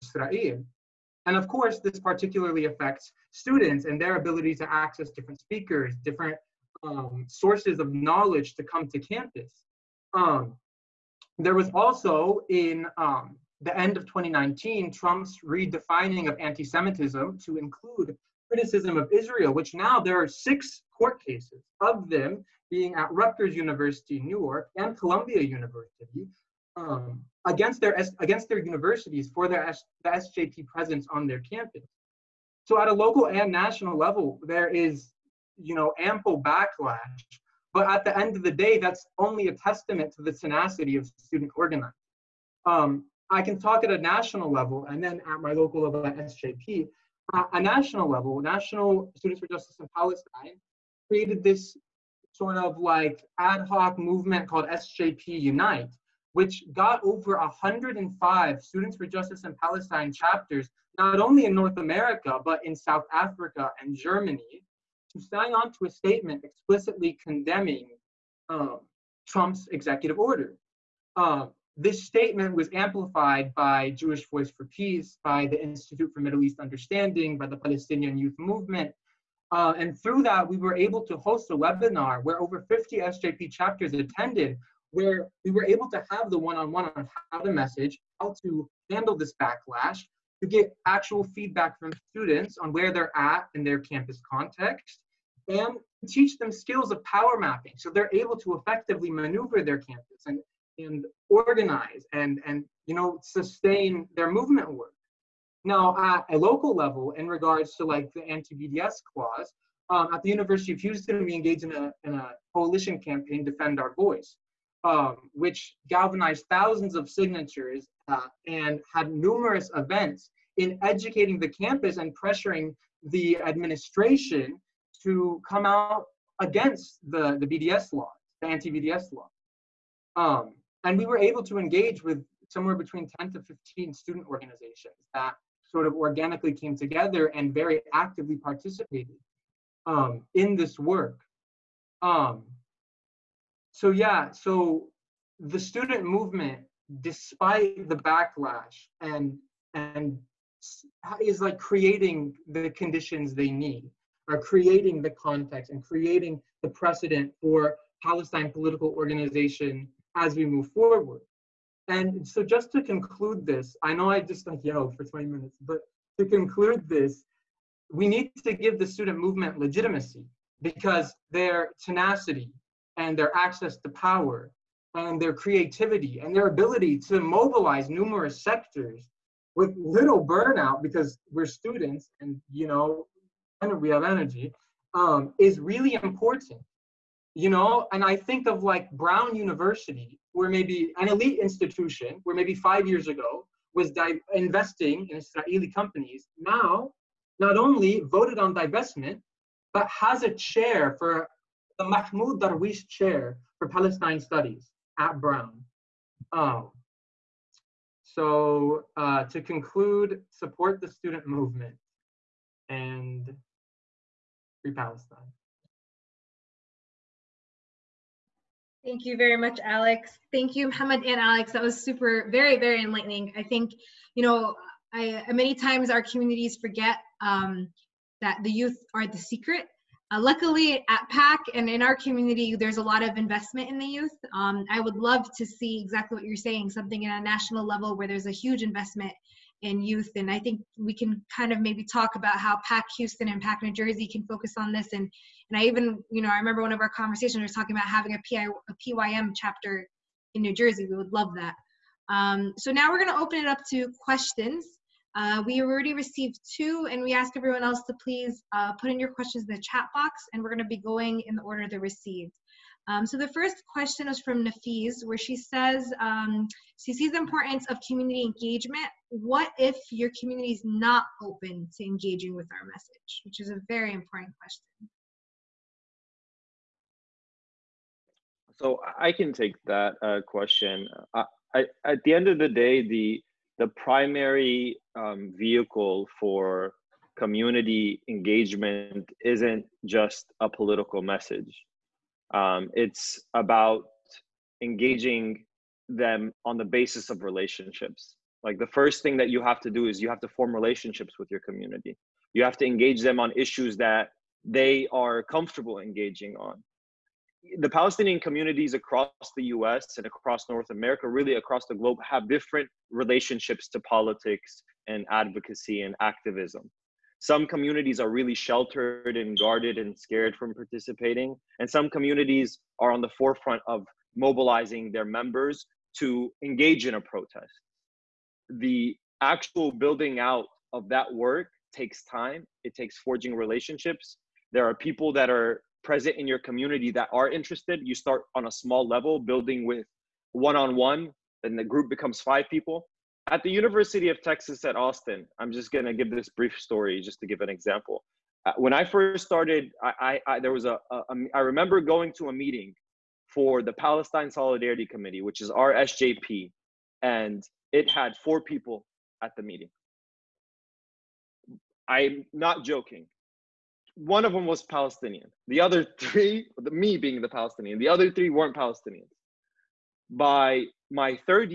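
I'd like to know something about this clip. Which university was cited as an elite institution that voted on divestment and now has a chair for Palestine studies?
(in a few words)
Brown University.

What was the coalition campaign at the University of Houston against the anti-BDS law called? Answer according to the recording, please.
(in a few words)
Defend Our Voice.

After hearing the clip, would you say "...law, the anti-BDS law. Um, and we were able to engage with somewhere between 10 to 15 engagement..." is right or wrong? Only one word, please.
wrong.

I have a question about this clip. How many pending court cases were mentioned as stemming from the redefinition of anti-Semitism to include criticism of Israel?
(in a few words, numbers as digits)
6.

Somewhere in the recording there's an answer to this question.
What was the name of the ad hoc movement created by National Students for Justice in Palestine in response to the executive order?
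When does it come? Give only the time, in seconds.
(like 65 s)
54 s.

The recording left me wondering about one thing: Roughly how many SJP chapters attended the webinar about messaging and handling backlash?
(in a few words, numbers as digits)
over 50.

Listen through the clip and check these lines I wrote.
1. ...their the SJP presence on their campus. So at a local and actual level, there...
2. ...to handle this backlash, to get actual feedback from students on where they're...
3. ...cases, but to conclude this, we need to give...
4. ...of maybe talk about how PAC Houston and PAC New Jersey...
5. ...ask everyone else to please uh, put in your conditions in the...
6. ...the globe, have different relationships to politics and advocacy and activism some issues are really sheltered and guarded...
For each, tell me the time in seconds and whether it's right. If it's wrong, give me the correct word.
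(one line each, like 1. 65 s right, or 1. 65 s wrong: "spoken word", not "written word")
1. 29 s wrong: "national", not "actual"
2. 88 s right
3. 165 s wrong: "minutes", not "cases"
4. 241 s right
5. 257 s wrong: "questions", not "conditions"
6. 311 s wrong: "communities", not "issues".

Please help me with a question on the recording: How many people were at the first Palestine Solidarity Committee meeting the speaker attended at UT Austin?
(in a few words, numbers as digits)
4.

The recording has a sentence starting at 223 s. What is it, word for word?
I think, you know, I, uh, many times our communities forget um, that the youth are the secret.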